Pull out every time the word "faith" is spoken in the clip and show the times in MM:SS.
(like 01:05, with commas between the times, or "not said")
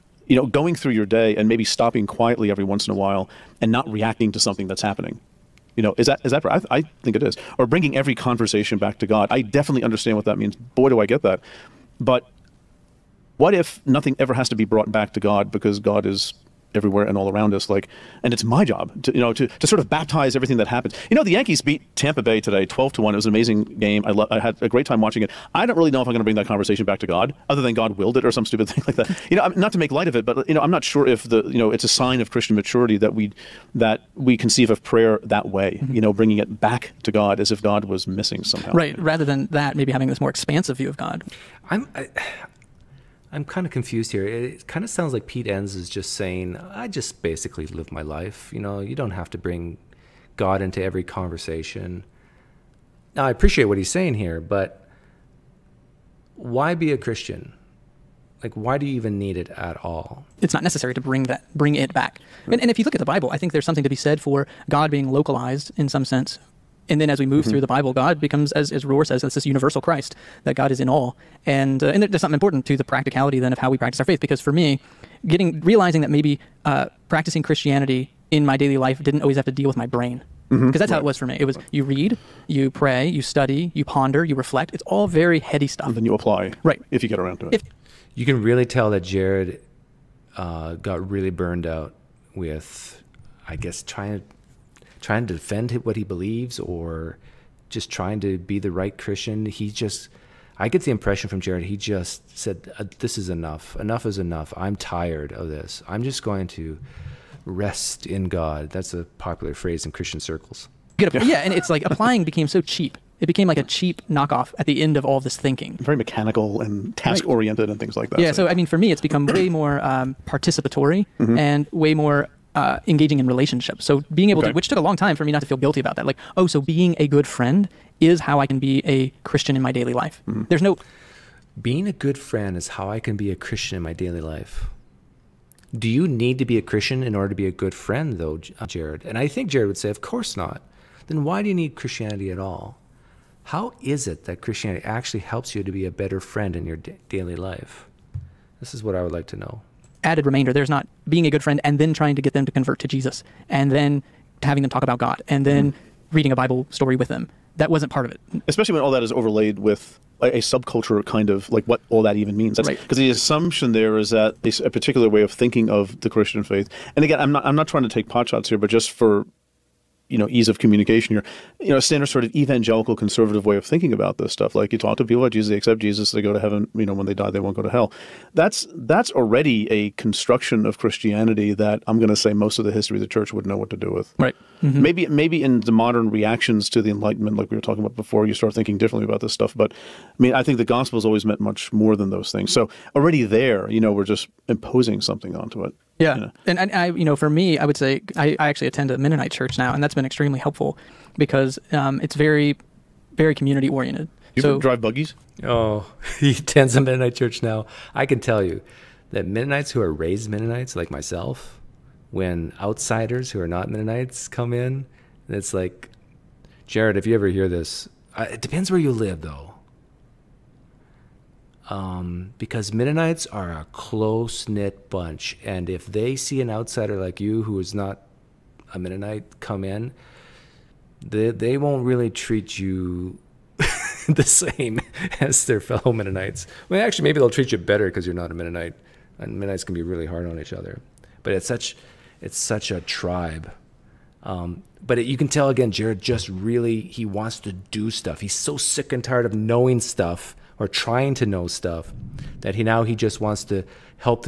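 01:14, 02:46.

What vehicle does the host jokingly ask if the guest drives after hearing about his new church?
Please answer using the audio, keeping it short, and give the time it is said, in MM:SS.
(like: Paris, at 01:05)
Buggies, at 03:24.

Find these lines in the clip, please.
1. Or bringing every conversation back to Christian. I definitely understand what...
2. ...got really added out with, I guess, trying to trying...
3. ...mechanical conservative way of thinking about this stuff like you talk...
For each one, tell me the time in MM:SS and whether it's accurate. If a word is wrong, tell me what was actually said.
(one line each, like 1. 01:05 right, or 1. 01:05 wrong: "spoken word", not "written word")
1. 00:07 wrong: "God", not "Christian"
2. 01:30 wrong: "burned", not "added"
3. 02:52 wrong: "evangelical", not "mechanical".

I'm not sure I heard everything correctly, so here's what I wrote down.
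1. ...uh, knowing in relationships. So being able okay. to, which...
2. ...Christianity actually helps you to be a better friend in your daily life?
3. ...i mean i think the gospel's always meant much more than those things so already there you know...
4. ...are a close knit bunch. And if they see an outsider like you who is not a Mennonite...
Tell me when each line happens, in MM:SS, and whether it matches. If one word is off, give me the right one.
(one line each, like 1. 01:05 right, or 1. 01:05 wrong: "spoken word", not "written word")
1. 02:02 wrong: "engaging", not "knowing"
2. 02:24 right
3. 03:09 right
4. 03:43 right.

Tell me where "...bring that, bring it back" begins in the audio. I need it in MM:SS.
01:01.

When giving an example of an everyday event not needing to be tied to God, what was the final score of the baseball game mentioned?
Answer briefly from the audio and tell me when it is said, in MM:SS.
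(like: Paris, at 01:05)
12 to 1, at 00:22.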